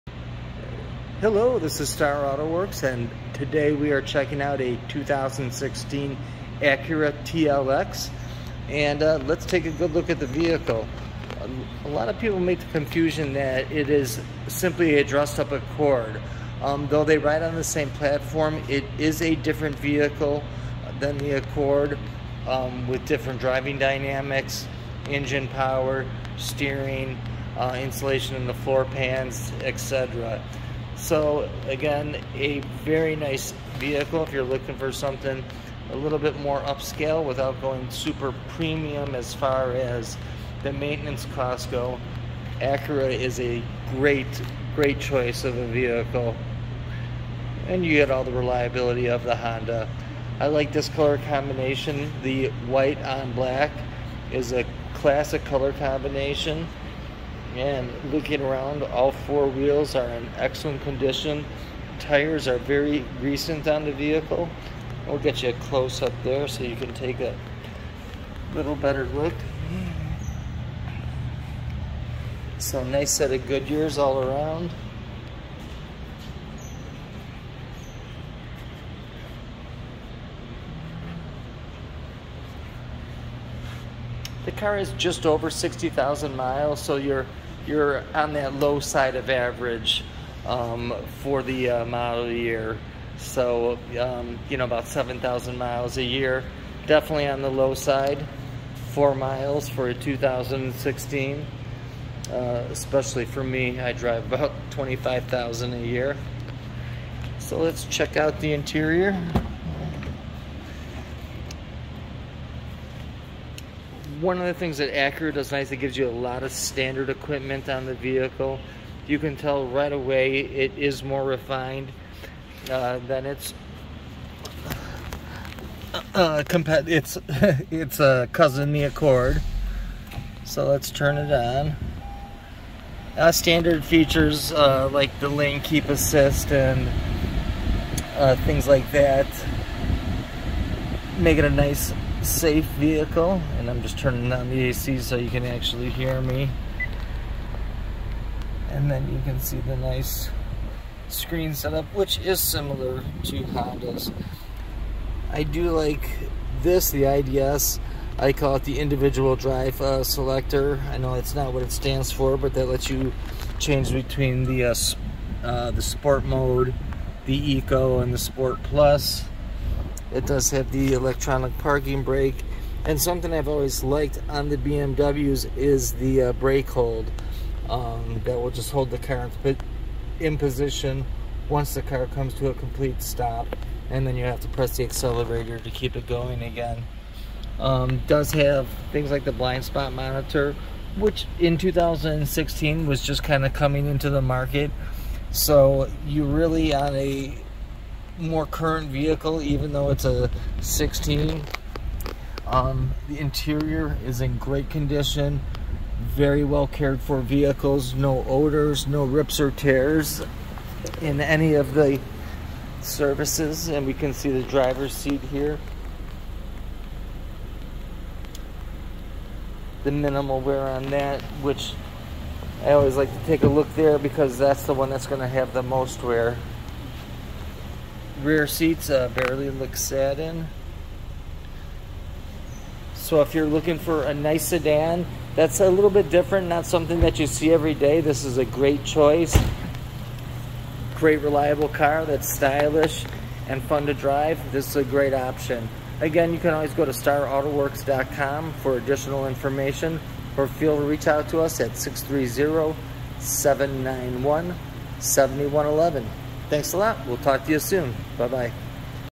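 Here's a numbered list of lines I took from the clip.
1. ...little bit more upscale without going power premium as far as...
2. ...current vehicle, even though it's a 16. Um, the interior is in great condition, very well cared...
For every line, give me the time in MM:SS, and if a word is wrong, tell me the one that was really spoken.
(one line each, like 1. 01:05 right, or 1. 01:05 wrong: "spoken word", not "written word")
1. 00:35 wrong: "super", not "power"
2. 03:18 right.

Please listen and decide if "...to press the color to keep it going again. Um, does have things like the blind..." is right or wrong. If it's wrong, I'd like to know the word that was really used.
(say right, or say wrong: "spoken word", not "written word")
wrong: "accelerator", not "color".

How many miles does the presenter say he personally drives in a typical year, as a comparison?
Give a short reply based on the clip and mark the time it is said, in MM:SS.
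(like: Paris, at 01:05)
25,000, at 01:44.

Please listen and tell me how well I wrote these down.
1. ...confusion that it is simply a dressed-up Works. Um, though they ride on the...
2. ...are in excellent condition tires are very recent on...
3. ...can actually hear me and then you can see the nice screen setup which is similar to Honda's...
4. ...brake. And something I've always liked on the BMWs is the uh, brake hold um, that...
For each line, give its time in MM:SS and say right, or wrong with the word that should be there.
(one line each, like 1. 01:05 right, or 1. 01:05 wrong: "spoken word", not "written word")
1. 00:12 wrong: "Accord", not "Works"
2. 00:59 right
3. 02:25 right
4. 02:52 right.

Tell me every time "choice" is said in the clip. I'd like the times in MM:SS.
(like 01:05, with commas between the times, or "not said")
00:44, 03:58.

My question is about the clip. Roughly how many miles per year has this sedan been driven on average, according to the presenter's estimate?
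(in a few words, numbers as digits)
7,000.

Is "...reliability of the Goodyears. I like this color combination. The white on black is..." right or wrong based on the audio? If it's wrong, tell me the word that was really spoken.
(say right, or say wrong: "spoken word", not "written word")
wrong: "Honda", not "Goodyears".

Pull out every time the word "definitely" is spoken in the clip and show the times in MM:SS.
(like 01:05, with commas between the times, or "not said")
01:36.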